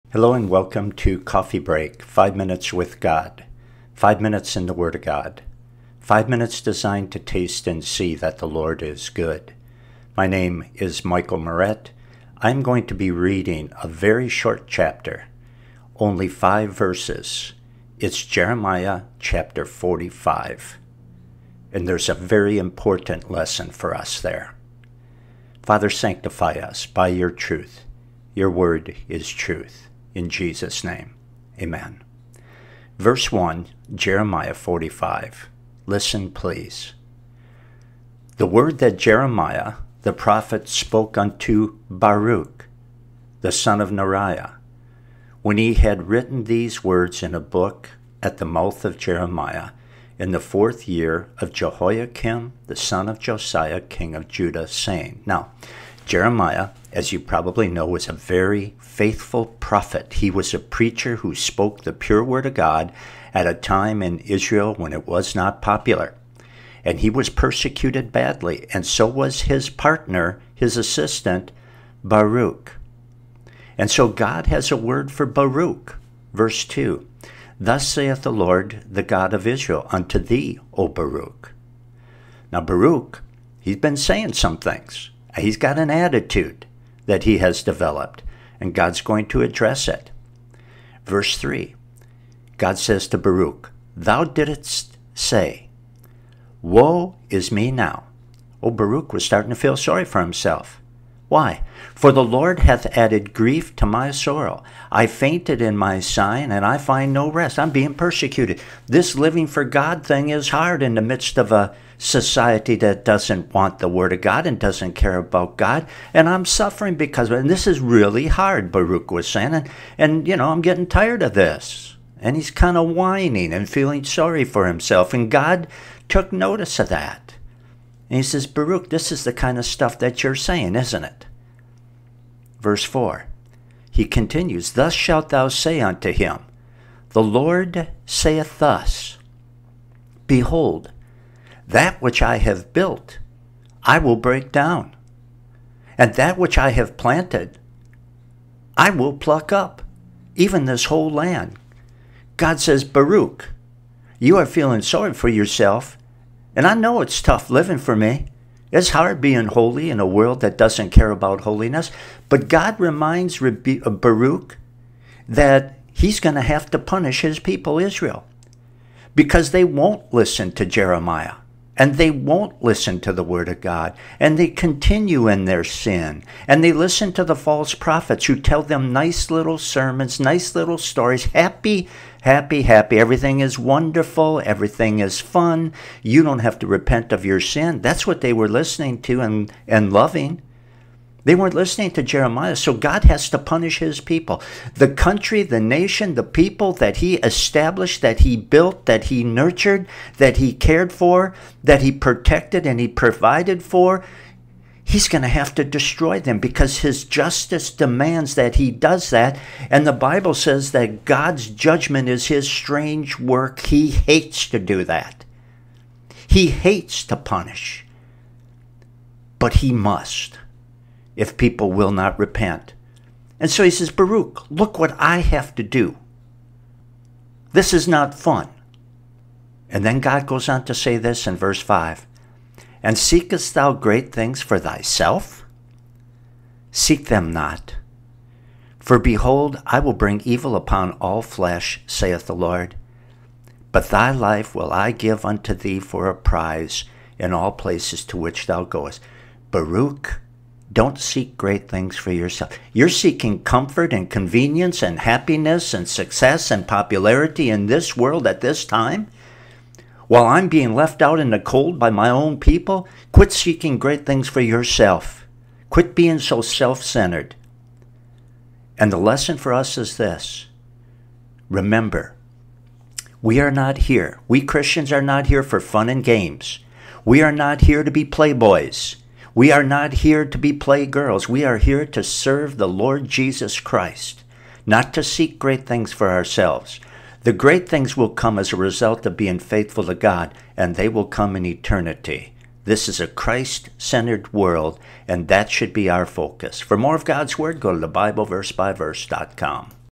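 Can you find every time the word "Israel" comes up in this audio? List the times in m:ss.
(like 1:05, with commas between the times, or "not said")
1:04, 1:19, 2:47.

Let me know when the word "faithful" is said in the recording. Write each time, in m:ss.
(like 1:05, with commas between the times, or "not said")
0:58, 4:49.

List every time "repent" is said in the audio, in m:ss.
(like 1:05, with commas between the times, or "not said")
3:06, 3:42.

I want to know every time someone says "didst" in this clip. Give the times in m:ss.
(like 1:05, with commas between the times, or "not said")
1:34.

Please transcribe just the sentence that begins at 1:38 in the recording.
Oh, Baruch was starting to feel sorry for himself.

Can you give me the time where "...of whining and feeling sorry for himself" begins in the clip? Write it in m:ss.
2:02.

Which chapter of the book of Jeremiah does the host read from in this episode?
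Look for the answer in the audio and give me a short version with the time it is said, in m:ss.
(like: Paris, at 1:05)
45, at 0:18.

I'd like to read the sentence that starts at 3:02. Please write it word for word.
Everything is wonderful, everything is fun.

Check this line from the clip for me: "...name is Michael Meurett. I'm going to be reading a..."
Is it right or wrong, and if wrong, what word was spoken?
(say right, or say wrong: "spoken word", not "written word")
right.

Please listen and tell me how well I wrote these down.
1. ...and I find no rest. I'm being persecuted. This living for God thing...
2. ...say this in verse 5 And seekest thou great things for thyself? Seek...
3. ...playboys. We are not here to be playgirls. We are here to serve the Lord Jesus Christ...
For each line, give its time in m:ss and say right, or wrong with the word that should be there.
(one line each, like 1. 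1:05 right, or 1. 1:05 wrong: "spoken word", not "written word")
1. 1:46 right
2. 3:50 right
3. 4:38 right.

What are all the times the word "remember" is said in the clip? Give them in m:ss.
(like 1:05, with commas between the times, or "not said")
4:31.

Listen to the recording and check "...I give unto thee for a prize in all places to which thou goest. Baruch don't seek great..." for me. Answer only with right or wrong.
right.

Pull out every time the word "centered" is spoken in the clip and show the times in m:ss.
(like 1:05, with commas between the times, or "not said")
4:26, 4:53.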